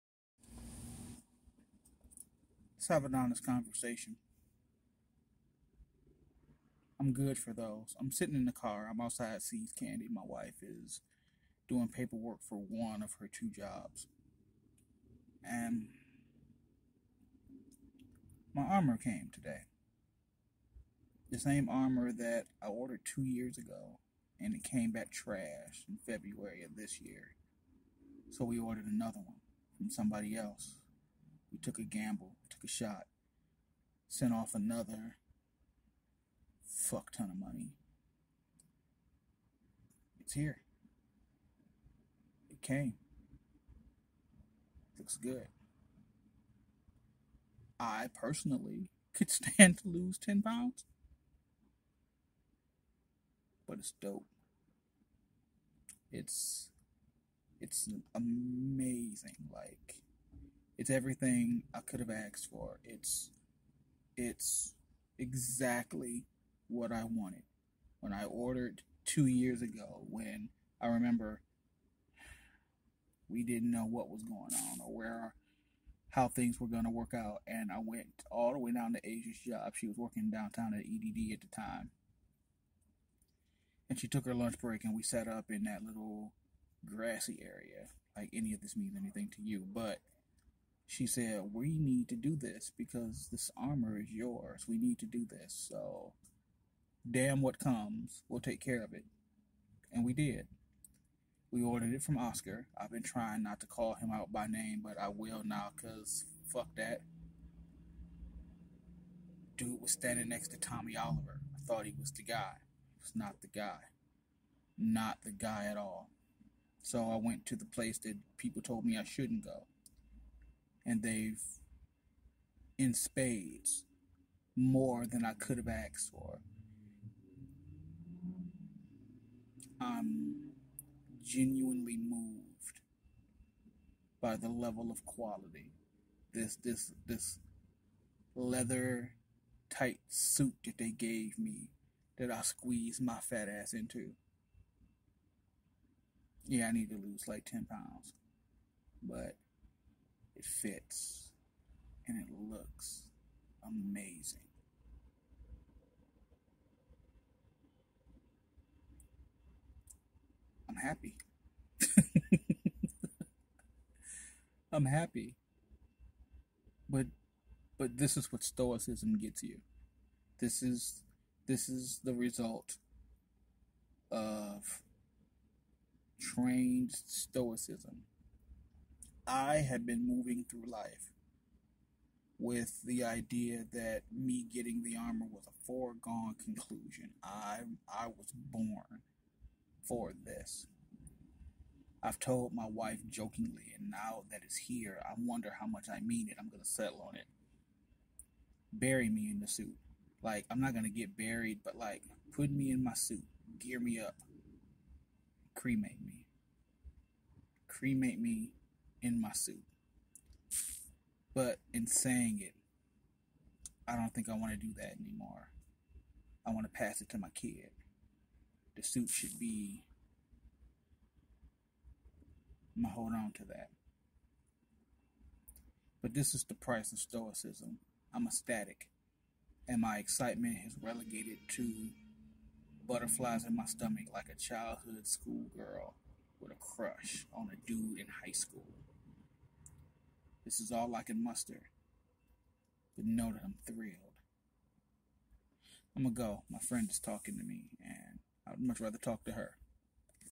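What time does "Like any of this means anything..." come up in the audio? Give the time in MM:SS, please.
01:28.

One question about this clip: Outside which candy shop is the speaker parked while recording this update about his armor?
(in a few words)
See's Candy.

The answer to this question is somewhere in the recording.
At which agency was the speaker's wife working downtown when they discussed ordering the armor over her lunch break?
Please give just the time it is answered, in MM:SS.
01:20.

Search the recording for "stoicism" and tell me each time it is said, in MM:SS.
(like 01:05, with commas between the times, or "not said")
02:48, 02:57, 03:46.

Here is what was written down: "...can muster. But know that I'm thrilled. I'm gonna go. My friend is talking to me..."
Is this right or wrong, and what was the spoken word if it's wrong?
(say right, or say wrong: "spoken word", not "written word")
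right.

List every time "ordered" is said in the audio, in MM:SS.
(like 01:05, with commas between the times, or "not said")
00:22, 00:28, 01:08, 01:41.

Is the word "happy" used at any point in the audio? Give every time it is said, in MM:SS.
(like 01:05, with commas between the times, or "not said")
02:40, 02:44.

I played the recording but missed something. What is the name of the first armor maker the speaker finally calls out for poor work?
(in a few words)
Oscar.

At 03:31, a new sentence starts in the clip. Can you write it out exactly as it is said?
But in saying it, I don't think I want to do that anymore.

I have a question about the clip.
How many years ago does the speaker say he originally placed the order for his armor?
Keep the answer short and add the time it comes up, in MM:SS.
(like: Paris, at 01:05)
2 years, at 00:23.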